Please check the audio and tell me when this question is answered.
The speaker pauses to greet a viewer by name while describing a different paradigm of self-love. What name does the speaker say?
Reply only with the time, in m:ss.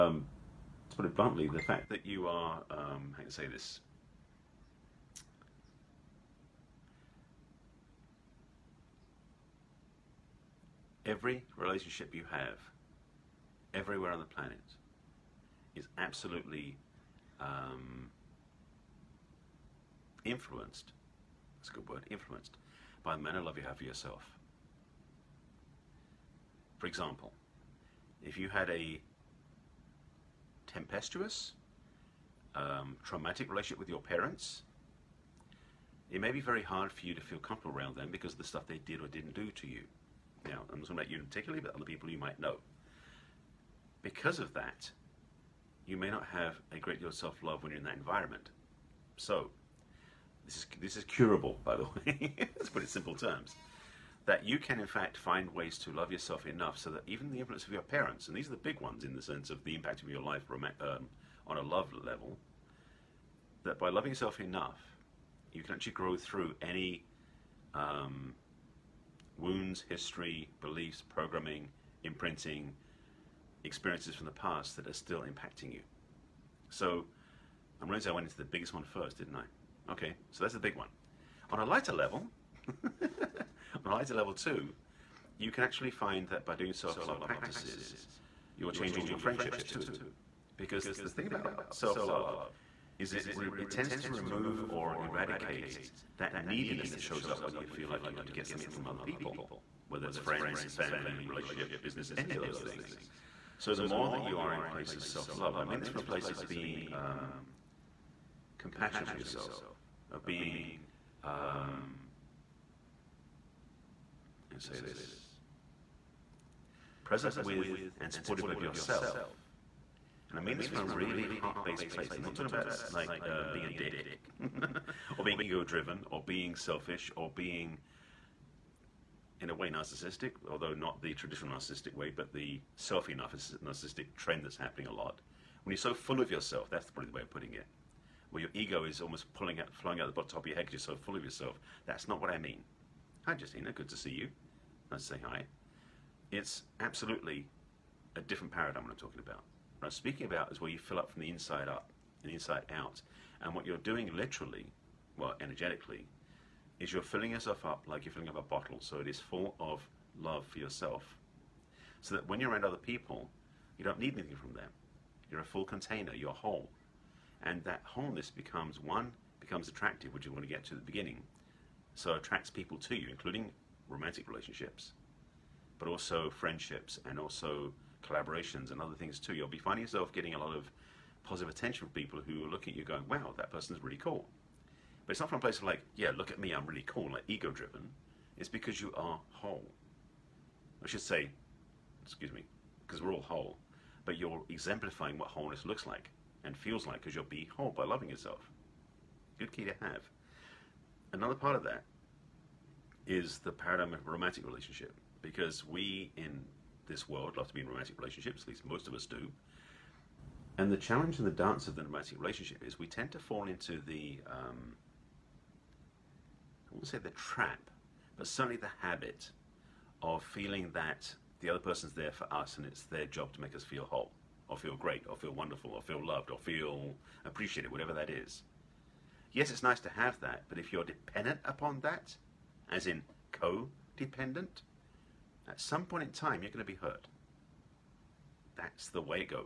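2:23.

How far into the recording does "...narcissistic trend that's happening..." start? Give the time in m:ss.
2:13.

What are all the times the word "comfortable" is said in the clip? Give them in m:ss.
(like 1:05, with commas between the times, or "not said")
0:37.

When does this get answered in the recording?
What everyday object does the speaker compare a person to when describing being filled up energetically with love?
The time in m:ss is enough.
2:38.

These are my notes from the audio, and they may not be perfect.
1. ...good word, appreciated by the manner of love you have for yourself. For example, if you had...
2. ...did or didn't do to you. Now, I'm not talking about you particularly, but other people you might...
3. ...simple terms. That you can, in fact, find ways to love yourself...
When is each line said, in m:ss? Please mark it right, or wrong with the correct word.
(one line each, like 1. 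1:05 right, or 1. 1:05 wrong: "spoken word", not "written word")
1. 0:21 wrong: "influenced", not "appreciated"
2. 0:38 right
3. 0:52 right.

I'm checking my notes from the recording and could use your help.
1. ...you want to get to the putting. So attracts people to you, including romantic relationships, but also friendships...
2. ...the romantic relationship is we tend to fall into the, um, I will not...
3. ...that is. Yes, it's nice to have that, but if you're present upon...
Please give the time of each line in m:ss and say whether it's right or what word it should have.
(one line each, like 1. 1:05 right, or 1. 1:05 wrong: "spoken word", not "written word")
1. 2:50 wrong: "beginning", not "putting"
2. 3:31 right
3. 3:47 wrong: "dependent", not "present".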